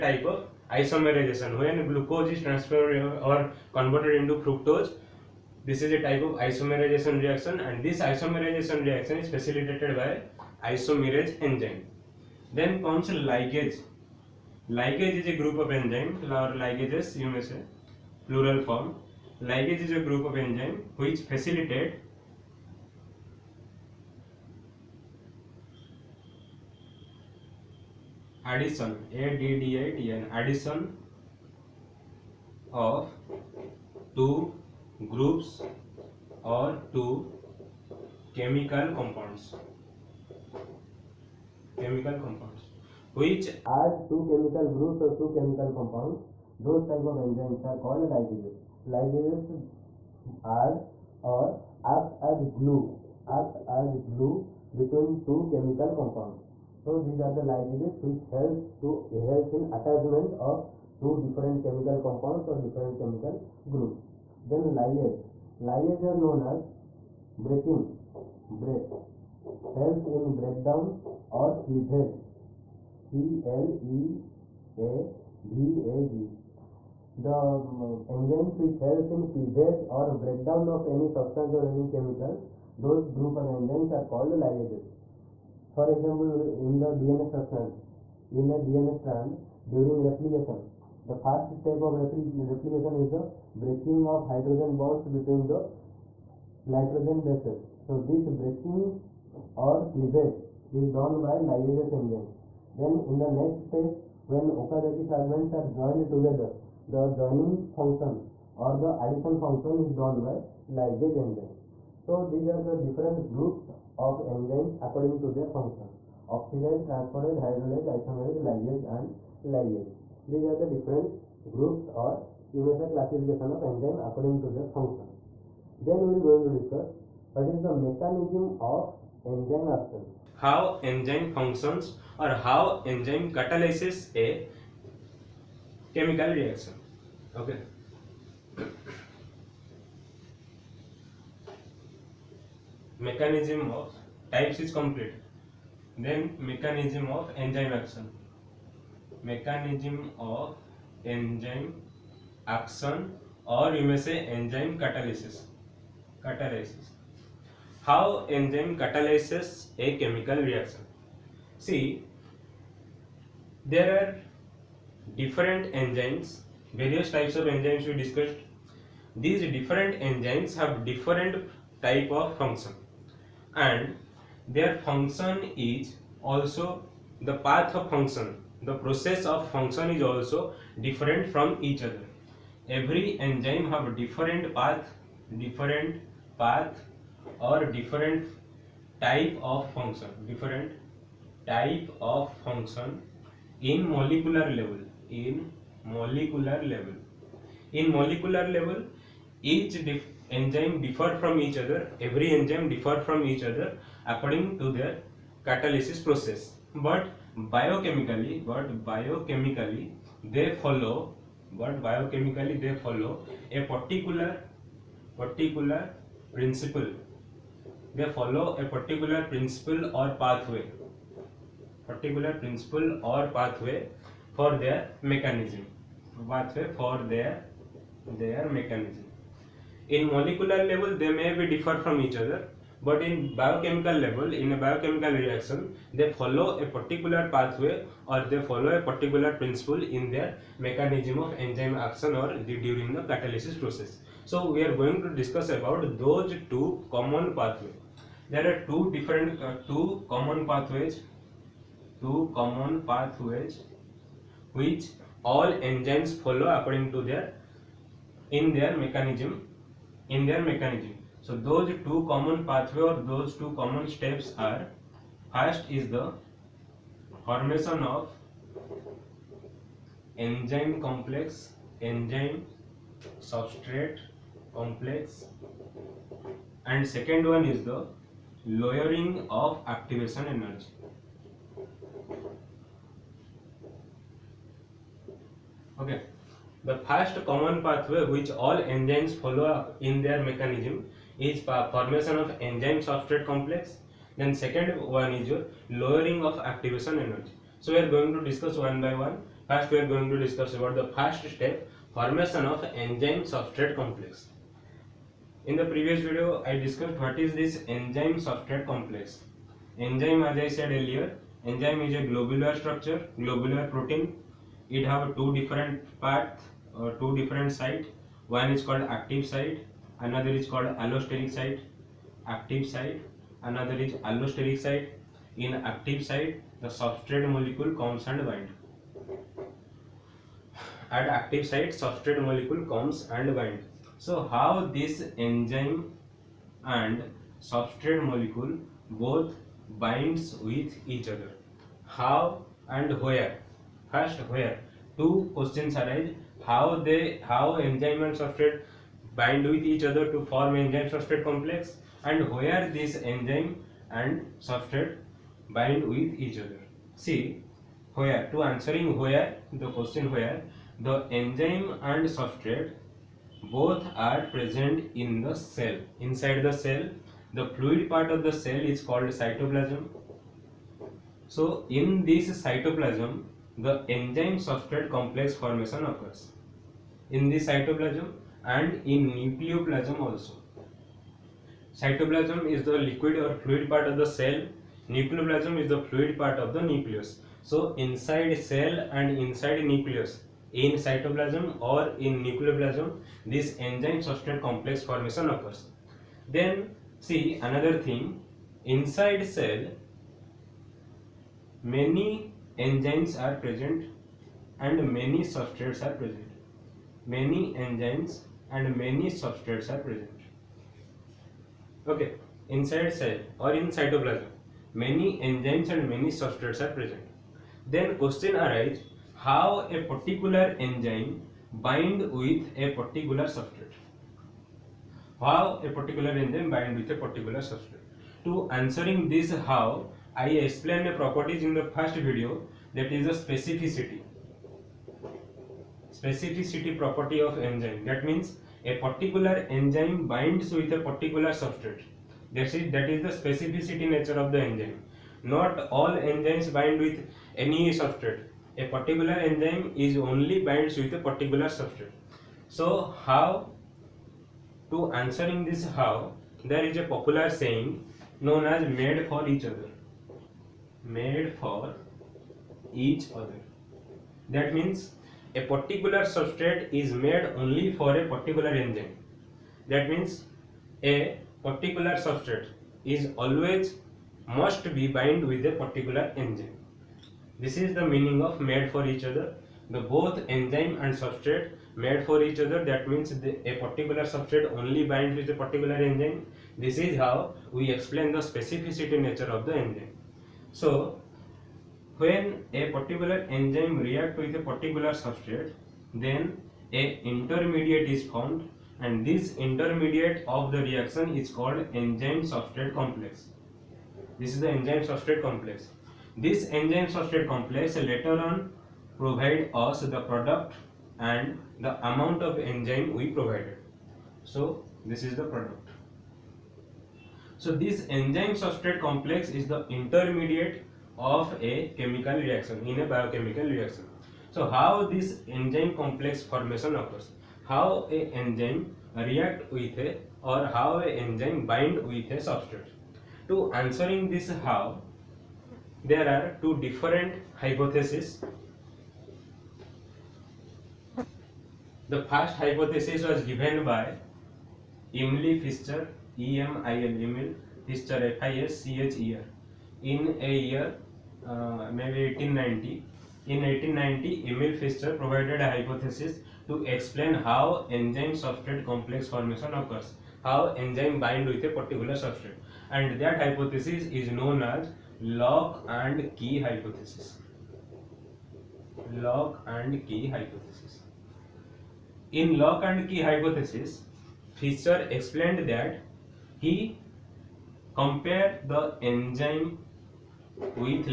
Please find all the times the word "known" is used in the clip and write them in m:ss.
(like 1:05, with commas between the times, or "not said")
1:06, 7:38, 9:24.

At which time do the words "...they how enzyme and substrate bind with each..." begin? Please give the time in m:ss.
5:46.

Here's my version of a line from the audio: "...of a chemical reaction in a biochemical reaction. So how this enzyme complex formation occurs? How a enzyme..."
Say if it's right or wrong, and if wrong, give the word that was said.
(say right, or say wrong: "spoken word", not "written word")
right.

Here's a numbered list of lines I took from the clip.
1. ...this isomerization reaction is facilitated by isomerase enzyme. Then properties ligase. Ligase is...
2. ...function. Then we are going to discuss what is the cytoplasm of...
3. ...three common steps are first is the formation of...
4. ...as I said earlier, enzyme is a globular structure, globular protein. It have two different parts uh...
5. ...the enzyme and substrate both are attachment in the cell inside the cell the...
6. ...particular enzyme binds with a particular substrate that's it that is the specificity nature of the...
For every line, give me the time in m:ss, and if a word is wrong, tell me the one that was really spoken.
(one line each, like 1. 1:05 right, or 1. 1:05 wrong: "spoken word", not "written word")
1. 0:07 wrong: "comes", not "properties"
2. 2:04 wrong: "mechanism", not "cytoplasm"
3. 4:23 wrong: "two", not "three"
4. 5:10 right
5. 6:00 wrong: "present", not "attachment"
6. 7:18 right.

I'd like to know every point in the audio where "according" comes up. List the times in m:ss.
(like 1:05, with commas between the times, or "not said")
1:54, 2:03, 3:24, 4:16.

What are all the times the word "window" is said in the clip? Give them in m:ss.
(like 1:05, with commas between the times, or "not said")
not said.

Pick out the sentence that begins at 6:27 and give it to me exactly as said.
So inside cell and inside nucleus, in cytoplasm or in nucleoplasm, this enzyme substrate complex formation occurs.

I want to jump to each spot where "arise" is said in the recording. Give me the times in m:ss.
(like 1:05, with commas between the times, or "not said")
5:45, 6:58.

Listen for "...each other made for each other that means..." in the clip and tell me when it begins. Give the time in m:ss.
7:39.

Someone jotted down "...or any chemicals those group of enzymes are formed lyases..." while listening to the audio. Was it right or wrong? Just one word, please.
wrong.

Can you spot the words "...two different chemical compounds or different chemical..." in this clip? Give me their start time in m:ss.
1:01.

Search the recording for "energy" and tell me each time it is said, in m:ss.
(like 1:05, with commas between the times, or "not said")
4:40, 4:57.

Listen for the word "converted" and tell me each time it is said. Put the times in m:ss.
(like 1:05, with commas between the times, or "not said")
0:03.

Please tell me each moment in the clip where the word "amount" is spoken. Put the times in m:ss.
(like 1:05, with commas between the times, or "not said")
8:31.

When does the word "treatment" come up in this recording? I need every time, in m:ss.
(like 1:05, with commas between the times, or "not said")
not said.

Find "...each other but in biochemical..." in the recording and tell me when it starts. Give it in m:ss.
3:52.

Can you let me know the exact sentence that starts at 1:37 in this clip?
So this breaking or cleavage is done by lyase enzyme.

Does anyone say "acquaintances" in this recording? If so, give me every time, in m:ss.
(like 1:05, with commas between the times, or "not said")
not said.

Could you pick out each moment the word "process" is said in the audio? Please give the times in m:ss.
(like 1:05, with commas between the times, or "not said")
2:58, 3:26, 4:03.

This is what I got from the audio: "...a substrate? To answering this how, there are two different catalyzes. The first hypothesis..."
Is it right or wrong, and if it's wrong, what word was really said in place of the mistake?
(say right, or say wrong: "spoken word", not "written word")
wrong: "hypotheses", not "catalyzes".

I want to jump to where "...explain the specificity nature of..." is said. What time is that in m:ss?
8:07.